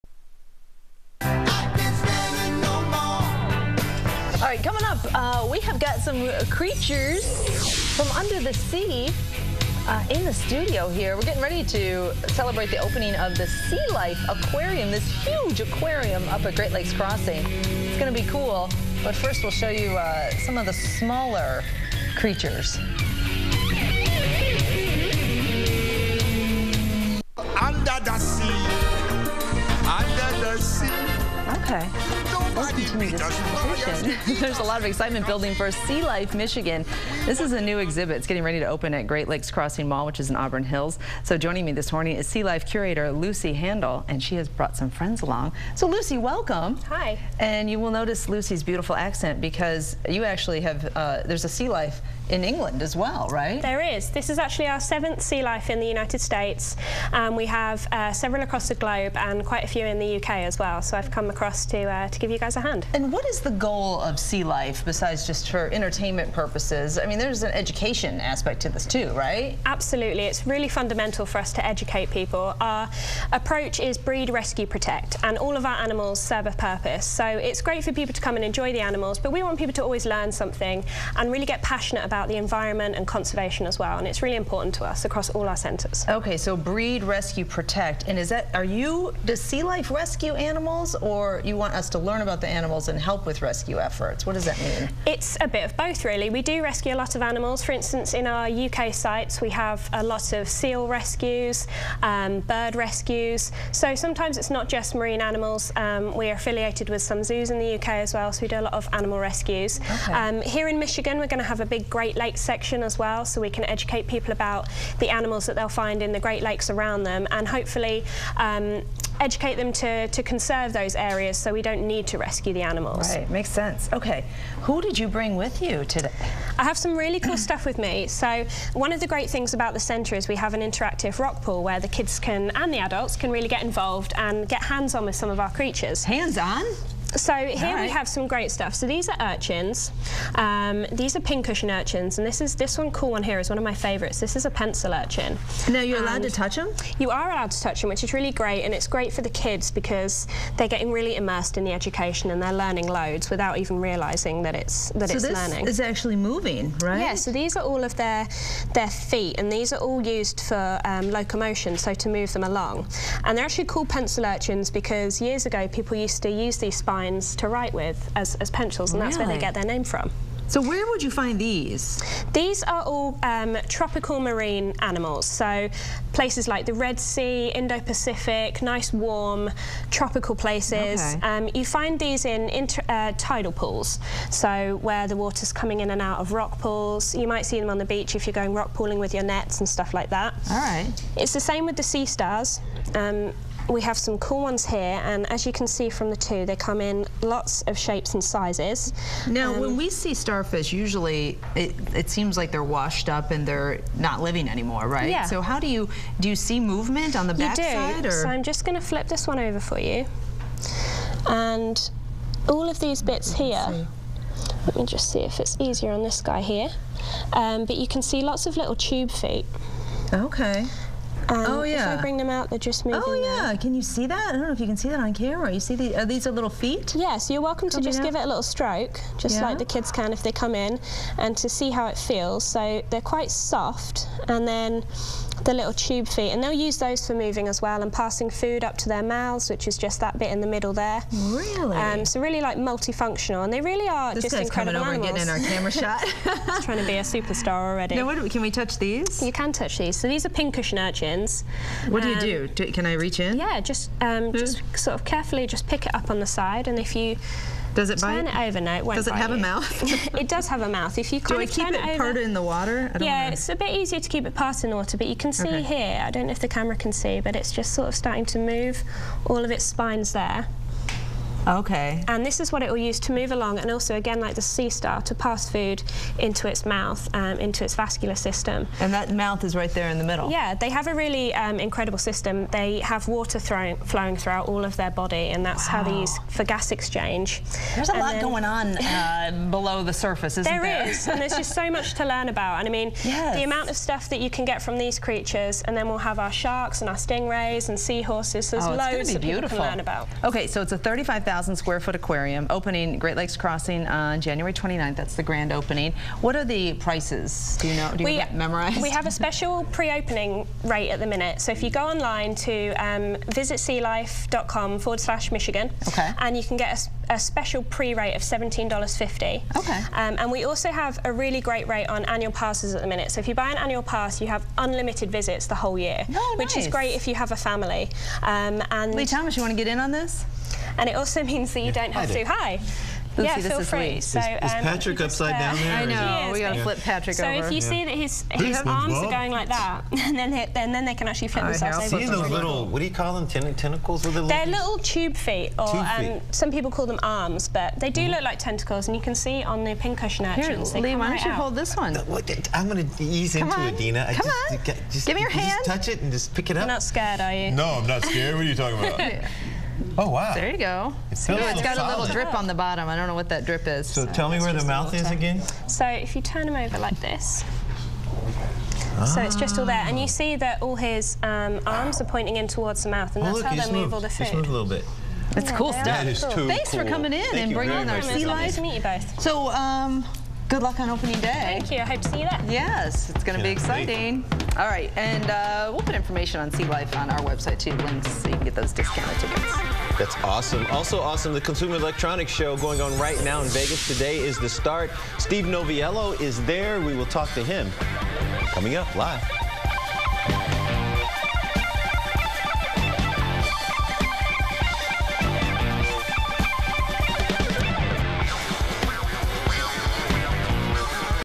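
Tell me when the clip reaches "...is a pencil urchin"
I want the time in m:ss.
2:24.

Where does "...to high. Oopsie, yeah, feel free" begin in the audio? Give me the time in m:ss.
5:32.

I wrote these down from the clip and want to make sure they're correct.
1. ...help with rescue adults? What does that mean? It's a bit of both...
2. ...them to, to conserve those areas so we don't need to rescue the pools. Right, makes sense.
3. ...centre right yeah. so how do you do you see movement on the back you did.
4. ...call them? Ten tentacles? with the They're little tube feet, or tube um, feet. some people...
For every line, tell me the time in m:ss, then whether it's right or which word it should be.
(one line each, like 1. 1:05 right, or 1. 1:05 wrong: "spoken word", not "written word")
1. 1:32 wrong: "efforts", not "adults"
2. 1:59 wrong: "animals", not "pools"
3. 3:24 wrong: "anymore", not "centre"
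4. 5:42 right.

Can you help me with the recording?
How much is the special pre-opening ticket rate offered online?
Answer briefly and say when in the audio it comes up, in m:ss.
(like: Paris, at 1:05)
$17.50, at 5:18.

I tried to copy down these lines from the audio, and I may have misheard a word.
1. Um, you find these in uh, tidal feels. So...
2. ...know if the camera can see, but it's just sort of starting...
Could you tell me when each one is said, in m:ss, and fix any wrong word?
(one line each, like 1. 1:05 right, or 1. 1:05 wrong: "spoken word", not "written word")
1. 3:01 wrong: "pools", not "feels"
2. 4:26 right.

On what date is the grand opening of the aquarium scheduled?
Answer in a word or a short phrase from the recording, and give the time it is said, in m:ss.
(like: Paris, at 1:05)
January 29, at 5:04.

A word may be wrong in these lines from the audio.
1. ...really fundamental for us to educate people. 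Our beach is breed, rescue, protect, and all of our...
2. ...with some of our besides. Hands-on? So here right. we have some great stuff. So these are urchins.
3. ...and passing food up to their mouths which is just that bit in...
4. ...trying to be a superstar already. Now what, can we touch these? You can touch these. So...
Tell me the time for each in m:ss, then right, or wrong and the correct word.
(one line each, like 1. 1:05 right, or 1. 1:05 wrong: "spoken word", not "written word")
1. 1:10 wrong: "approach", not "beach"
2. 2:15 wrong: "creatures", not "besides"
3. 3:57 right
4. 4:06 right.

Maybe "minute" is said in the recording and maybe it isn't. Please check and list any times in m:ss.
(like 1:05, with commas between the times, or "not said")
5:11, 5:22.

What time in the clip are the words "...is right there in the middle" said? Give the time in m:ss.
4:39.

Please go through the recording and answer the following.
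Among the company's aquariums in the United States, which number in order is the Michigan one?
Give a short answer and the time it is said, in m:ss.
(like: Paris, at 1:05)
seventh, at 0:54.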